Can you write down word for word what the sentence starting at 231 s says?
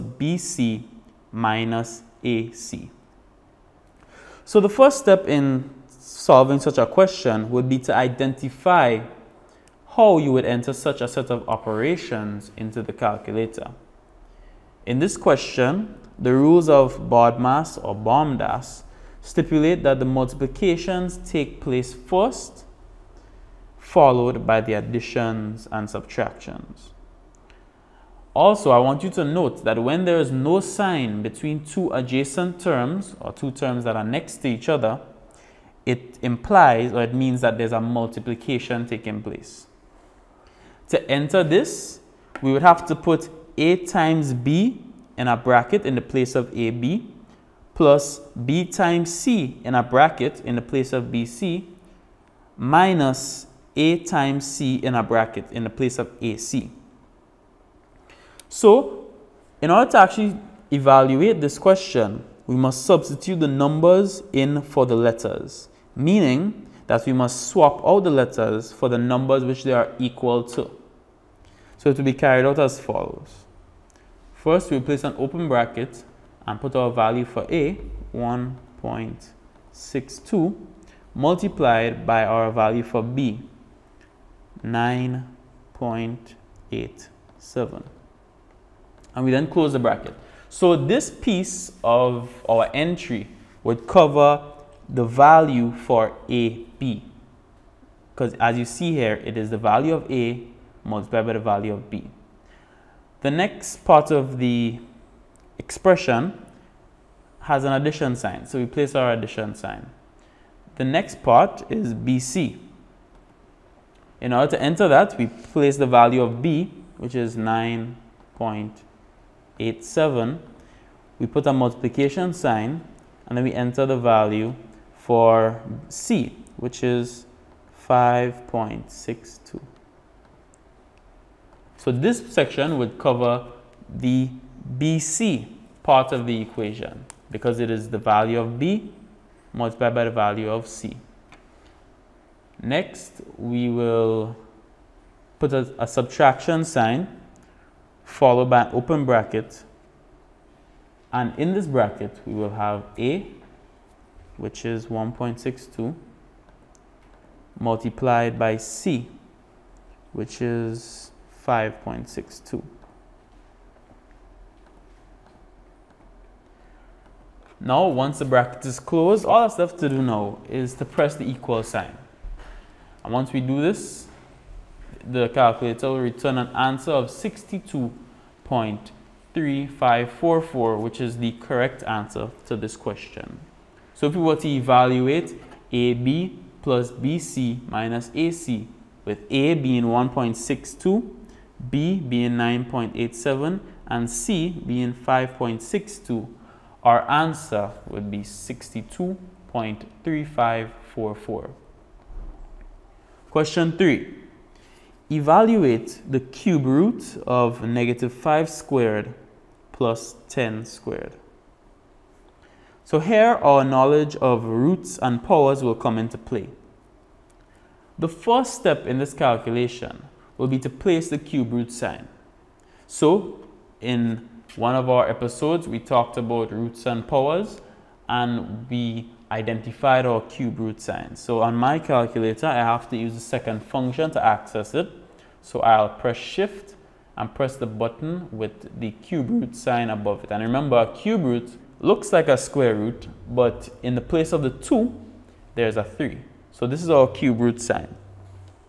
So on my calculator, I have to use the second function to access it.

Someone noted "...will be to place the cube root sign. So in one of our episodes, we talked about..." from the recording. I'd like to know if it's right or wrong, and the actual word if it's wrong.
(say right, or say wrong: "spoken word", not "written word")
right.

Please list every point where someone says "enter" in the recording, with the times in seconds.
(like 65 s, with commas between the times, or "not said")
10 s, 41 s, 114 s, 123 s.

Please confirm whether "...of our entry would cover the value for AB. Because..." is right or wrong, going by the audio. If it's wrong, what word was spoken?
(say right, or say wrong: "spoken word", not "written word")
right.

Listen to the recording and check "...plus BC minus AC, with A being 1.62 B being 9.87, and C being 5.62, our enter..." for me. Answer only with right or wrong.
wrong.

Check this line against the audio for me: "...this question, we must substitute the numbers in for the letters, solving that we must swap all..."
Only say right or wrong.
wrong.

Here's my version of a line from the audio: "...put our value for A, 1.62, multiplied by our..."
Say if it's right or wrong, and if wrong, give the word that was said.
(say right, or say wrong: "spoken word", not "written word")
right.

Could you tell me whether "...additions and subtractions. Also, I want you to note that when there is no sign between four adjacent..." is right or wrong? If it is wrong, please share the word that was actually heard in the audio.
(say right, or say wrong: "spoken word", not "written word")
wrong: "two", not "four".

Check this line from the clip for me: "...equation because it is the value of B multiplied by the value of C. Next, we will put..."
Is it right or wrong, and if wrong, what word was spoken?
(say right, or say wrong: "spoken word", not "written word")
right.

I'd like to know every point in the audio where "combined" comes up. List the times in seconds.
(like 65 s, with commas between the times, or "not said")
not said.